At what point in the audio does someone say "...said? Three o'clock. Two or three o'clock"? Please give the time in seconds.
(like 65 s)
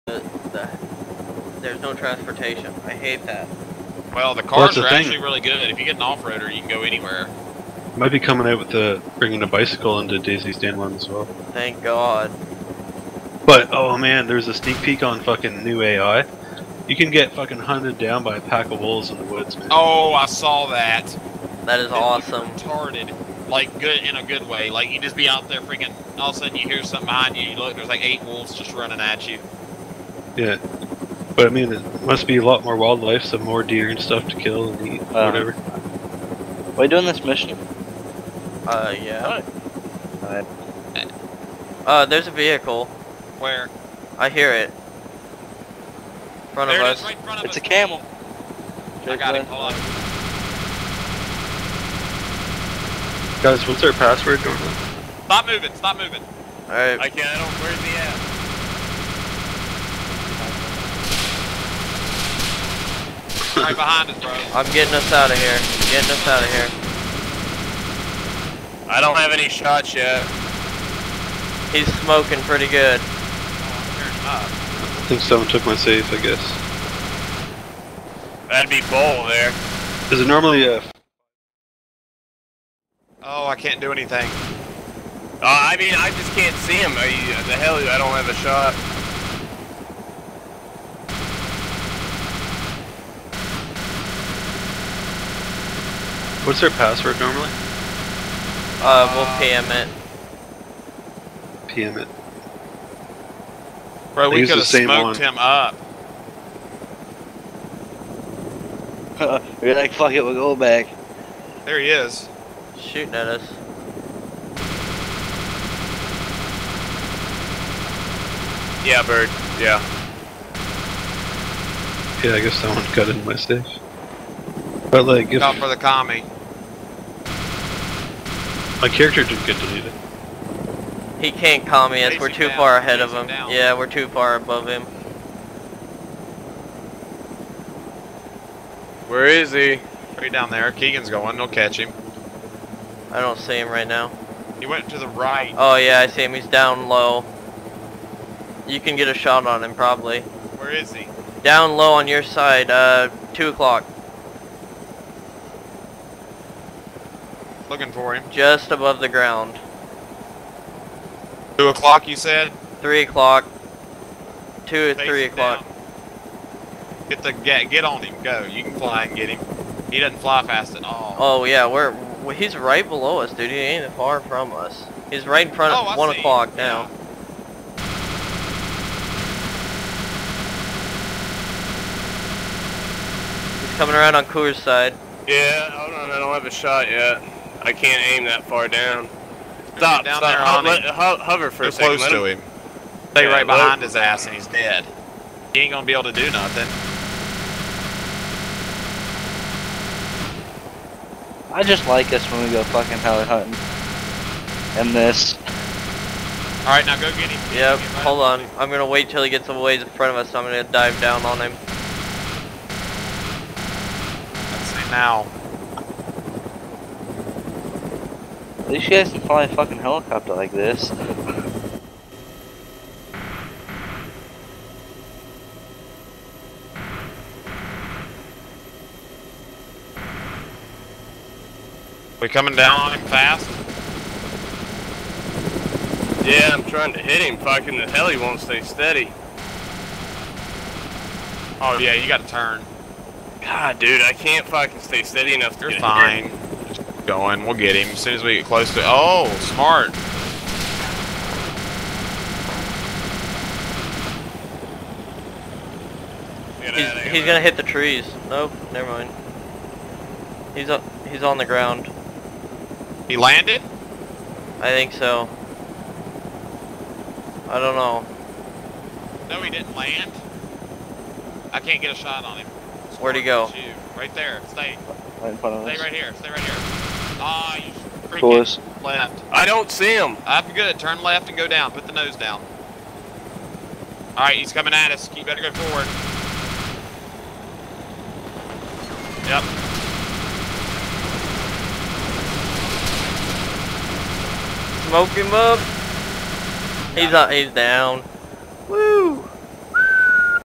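162 s.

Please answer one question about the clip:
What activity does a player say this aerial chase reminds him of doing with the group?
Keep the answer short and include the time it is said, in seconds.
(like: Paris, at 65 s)
heli hunting, at 202 s.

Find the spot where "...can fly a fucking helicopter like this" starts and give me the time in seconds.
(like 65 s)
219 s.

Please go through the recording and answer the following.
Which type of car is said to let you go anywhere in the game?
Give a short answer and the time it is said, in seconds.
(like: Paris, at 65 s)
off-roader, at 6 s.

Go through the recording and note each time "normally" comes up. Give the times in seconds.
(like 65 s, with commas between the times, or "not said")
80 s, 97 s.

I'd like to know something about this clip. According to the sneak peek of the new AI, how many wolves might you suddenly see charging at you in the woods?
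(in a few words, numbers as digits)
8.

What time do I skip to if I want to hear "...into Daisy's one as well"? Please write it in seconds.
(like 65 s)
9 s.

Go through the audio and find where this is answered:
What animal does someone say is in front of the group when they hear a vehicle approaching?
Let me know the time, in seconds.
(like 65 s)
47 s.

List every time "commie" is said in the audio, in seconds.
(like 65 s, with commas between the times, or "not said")
125 s, 131 s.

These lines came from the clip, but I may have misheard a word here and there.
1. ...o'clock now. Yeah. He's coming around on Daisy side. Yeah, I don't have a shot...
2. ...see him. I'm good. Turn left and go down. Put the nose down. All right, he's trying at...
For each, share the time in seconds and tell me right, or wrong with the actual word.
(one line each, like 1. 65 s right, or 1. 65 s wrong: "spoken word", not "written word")
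1. 176 s wrong: "Coors", not "Daisy"
2. 279 s wrong: "coming", not "trying".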